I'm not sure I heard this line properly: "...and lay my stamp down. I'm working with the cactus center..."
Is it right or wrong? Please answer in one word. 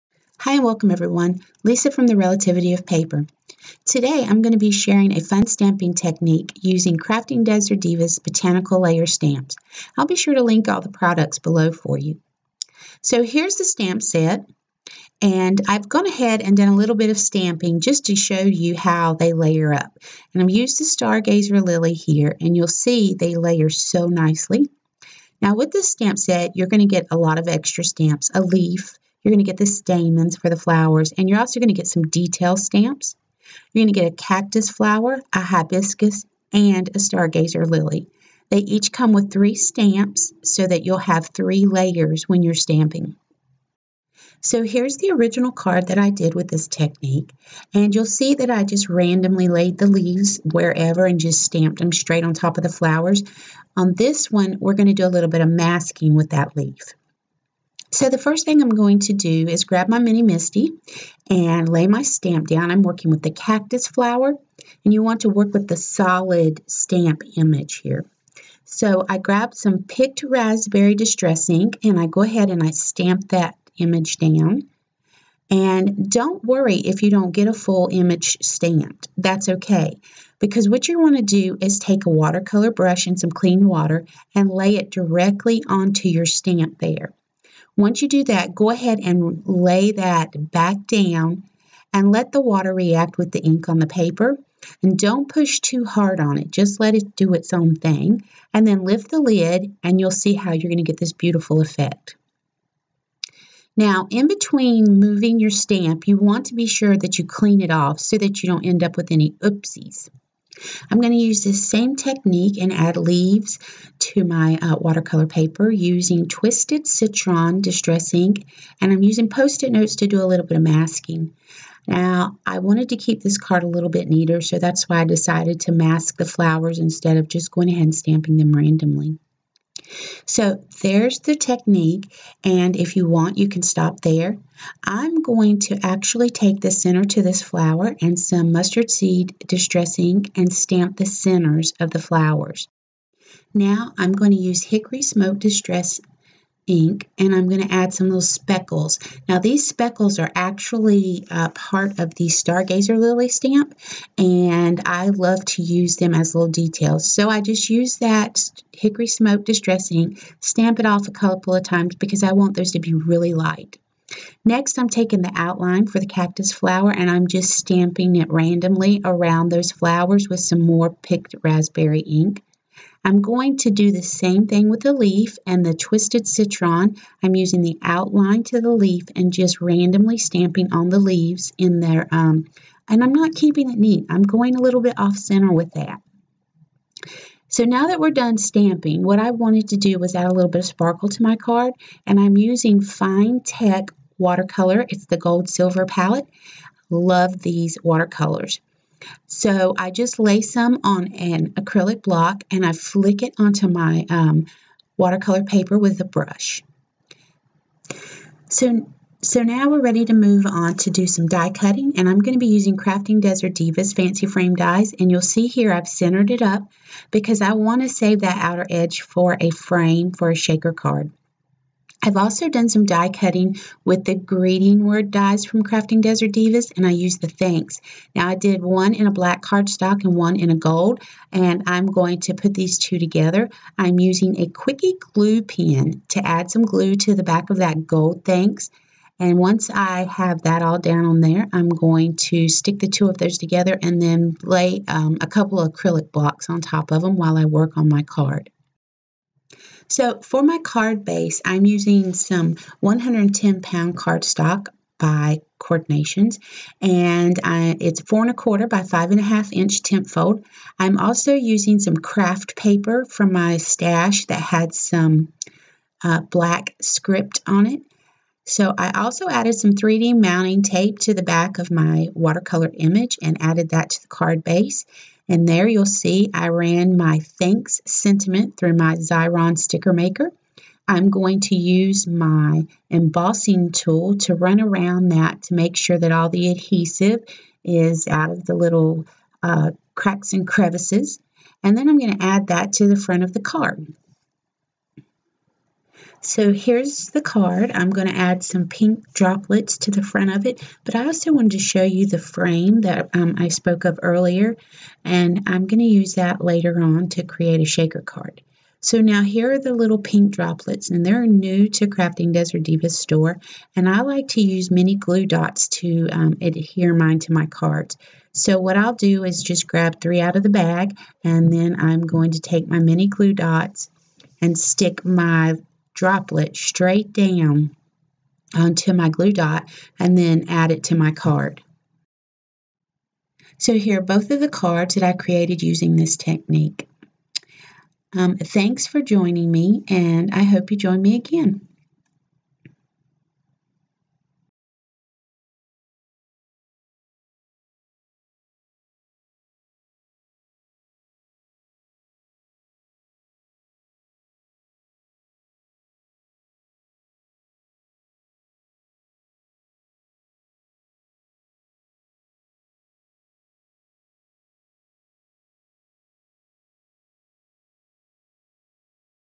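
wrong.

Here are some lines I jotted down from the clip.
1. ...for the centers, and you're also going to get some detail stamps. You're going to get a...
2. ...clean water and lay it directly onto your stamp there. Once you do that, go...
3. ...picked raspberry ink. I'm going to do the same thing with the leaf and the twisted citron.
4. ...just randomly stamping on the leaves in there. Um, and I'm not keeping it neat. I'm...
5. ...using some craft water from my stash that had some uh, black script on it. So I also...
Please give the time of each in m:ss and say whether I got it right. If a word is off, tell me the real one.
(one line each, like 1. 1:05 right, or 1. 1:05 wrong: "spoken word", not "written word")
1. 0:30 wrong: "flowers", not "centers"
2. 1:23 right
3. 2:50 right
4. 2:59 right
5. 4:21 wrong: "paper", not "water".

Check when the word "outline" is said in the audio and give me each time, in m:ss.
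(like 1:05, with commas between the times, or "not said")
2:45, 2:57.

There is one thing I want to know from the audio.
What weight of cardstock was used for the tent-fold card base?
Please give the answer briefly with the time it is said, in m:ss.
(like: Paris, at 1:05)
110 pound, at 4:12.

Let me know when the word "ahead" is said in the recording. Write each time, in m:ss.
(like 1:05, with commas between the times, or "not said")
0:16, 1:12, 1:28, 2:07.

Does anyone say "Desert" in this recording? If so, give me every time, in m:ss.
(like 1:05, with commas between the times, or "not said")
0:07, 3:33, 3:46, 5:12.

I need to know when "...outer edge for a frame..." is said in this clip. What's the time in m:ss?
3:38.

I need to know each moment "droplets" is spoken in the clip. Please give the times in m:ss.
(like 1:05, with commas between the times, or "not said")
4:59, 5:10, 5:25.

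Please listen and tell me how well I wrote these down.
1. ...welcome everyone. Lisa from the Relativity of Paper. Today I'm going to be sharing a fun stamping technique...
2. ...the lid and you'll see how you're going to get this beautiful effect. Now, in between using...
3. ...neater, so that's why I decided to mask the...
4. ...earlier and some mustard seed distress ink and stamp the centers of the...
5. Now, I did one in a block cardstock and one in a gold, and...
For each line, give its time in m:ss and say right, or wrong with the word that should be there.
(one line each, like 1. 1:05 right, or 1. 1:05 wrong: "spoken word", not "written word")
1. 0:00 right
2. 1:39 wrong: "moving", not "using"
3. 2:04 right
4. 2:17 wrong: "flower", not "earlier"
5. 3:48 wrong: "black", not "block".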